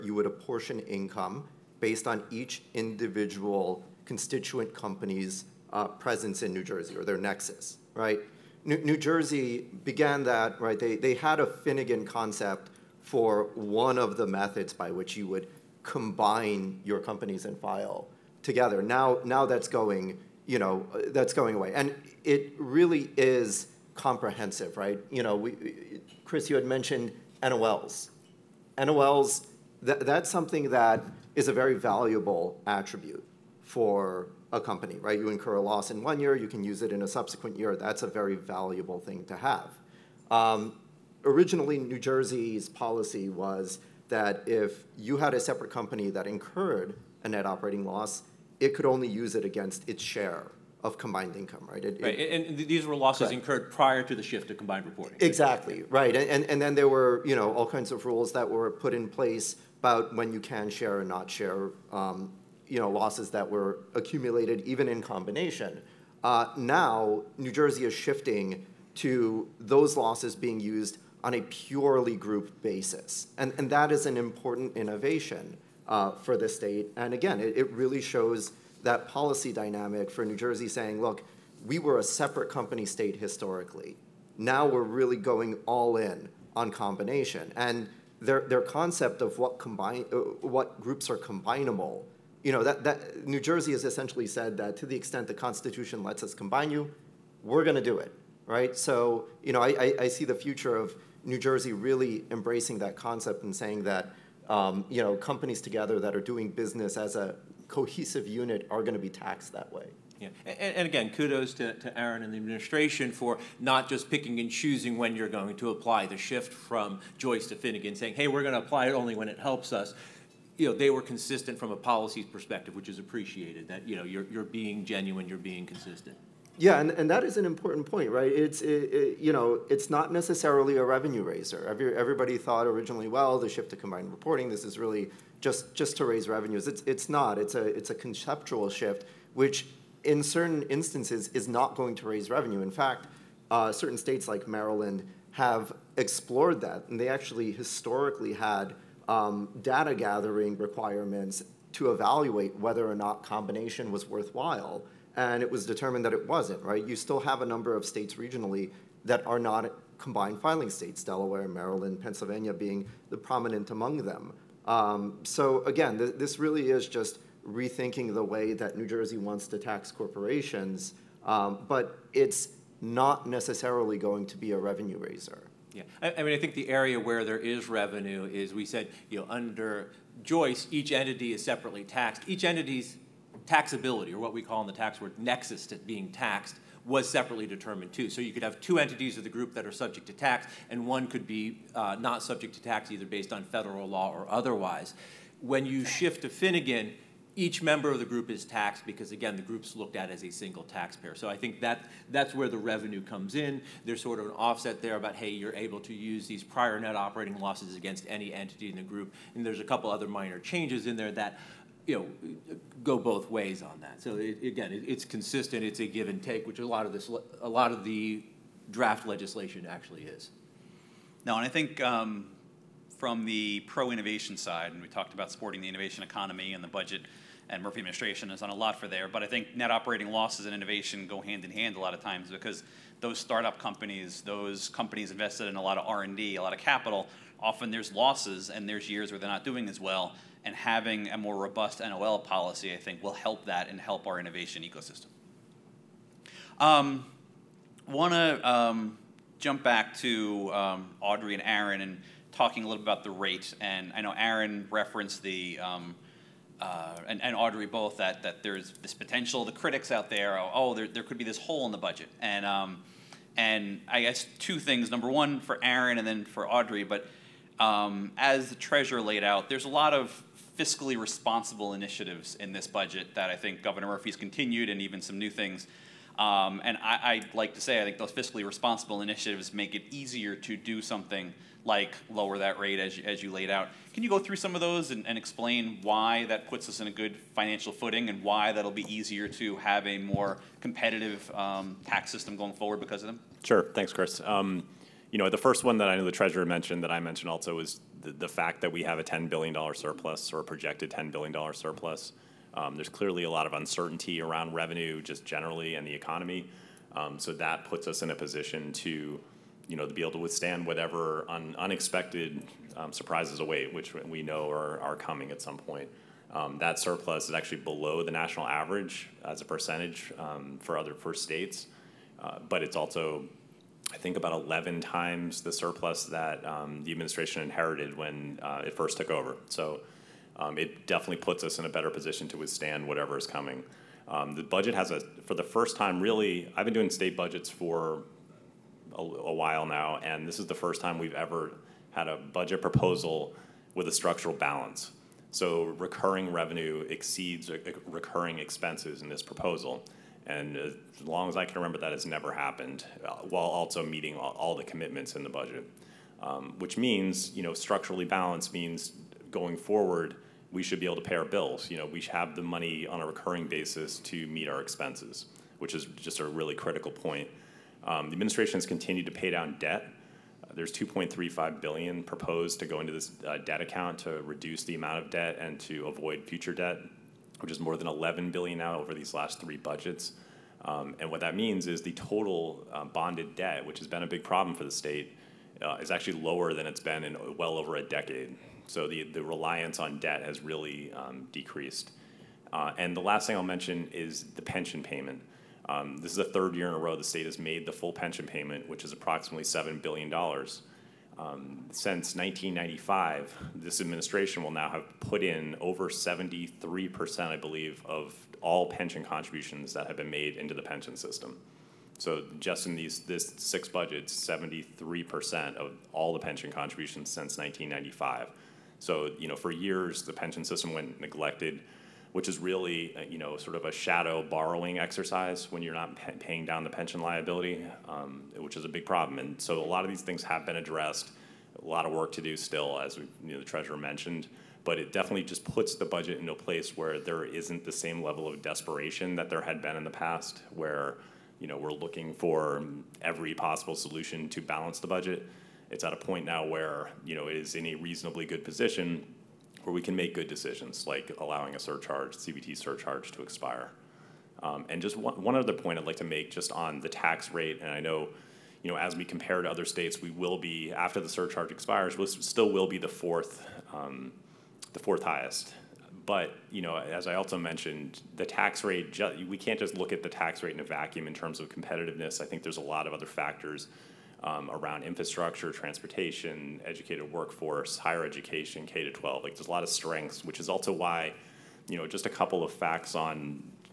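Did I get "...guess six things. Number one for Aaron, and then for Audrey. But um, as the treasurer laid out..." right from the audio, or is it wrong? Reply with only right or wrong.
wrong.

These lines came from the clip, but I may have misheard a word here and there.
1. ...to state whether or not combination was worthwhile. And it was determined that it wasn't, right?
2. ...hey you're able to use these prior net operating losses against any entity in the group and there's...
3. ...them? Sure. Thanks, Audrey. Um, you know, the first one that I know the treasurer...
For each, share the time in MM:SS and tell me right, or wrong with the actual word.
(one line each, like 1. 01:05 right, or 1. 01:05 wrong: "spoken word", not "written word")
1. 02:31 wrong: "evaluate", not "state"
2. 03:25 right
3. 04:53 wrong: "Chris", not "Audrey".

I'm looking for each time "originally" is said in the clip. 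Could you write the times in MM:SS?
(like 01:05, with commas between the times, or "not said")
00:41, 02:12.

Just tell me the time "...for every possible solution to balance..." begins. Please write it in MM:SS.
07:22.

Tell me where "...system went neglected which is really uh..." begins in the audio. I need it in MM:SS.
07:00.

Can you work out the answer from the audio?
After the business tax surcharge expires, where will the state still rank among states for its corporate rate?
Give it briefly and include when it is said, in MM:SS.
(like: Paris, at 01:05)
fourth highest, at 07:44.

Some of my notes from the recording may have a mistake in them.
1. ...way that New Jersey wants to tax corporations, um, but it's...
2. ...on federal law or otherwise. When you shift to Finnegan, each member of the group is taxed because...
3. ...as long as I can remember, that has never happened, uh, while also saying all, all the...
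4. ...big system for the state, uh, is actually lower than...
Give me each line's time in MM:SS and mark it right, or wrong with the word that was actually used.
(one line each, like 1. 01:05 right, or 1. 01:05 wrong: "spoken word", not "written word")
1. 02:48 right
2. 03:13 right
3. 05:50 wrong: "meeting", not "saying"
4. 06:24 wrong: "problem", not "system".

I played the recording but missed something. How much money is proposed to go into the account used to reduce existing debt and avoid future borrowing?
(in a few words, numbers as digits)
2.35 billion.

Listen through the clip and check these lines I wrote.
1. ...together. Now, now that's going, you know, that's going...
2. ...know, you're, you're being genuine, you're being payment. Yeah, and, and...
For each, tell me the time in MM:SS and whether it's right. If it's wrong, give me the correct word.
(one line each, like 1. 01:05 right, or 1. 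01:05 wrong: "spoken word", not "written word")
1. 00:18 right
2. 02:03 wrong: "consistent", not "payment".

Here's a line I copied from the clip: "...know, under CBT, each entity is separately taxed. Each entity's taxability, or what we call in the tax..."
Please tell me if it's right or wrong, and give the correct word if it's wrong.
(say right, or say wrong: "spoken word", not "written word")
wrong: "Joyce", not "CBT".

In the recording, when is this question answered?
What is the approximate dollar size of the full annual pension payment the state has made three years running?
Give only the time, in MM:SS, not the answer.
06:39.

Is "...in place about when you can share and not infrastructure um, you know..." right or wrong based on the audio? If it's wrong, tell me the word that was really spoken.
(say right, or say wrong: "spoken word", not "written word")
wrong: "share", not "infrastructure".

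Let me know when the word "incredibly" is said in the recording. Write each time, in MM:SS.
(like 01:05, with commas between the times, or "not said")
not said.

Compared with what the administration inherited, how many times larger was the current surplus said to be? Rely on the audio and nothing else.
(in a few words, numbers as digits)
11 times.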